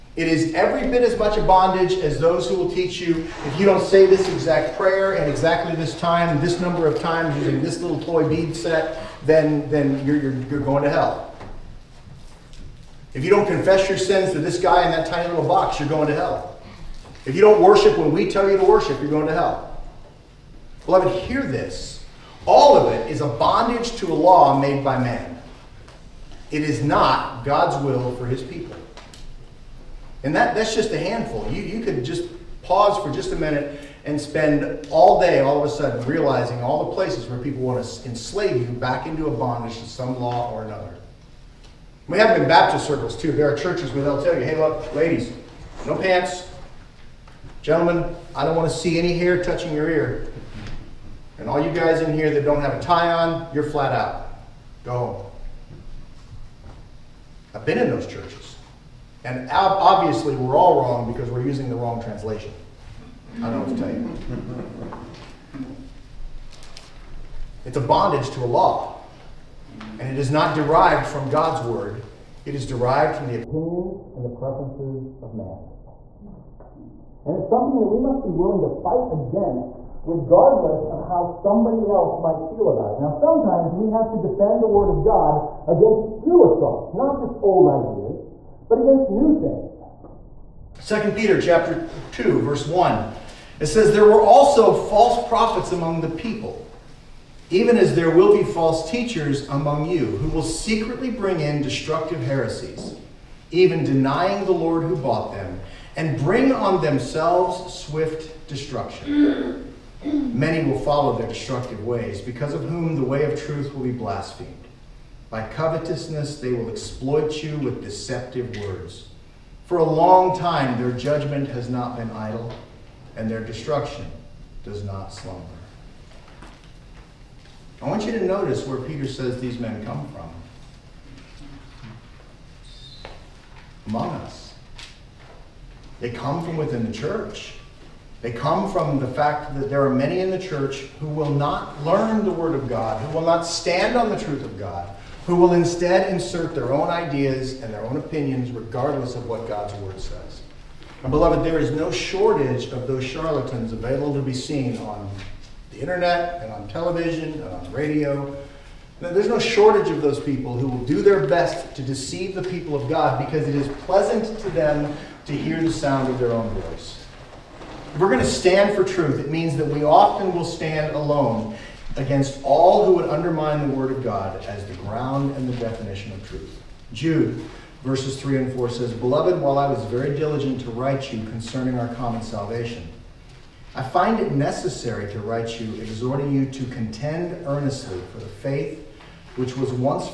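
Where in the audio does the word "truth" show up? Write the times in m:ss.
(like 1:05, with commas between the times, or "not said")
1:53, 2:24, 2:48, 2:56.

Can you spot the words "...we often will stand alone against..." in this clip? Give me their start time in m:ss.
2:49.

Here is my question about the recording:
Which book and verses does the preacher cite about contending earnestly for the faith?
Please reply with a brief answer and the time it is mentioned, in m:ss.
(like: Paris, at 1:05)
Jude verses 3 and 4, at 2:56.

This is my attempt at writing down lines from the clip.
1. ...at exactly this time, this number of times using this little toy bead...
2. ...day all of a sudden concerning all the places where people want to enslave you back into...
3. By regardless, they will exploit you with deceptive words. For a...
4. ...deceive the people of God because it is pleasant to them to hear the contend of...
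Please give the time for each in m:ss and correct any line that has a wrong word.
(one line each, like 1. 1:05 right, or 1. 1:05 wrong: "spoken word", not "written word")
1. 0:05 right
2. 0:35 wrong: "realizing", not "concerning"
3. 1:55 wrong: "covetousness", not "regardless"
4. 2:41 wrong: "sound", not "contend".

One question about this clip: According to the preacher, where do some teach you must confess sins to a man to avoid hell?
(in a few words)
tiny little box.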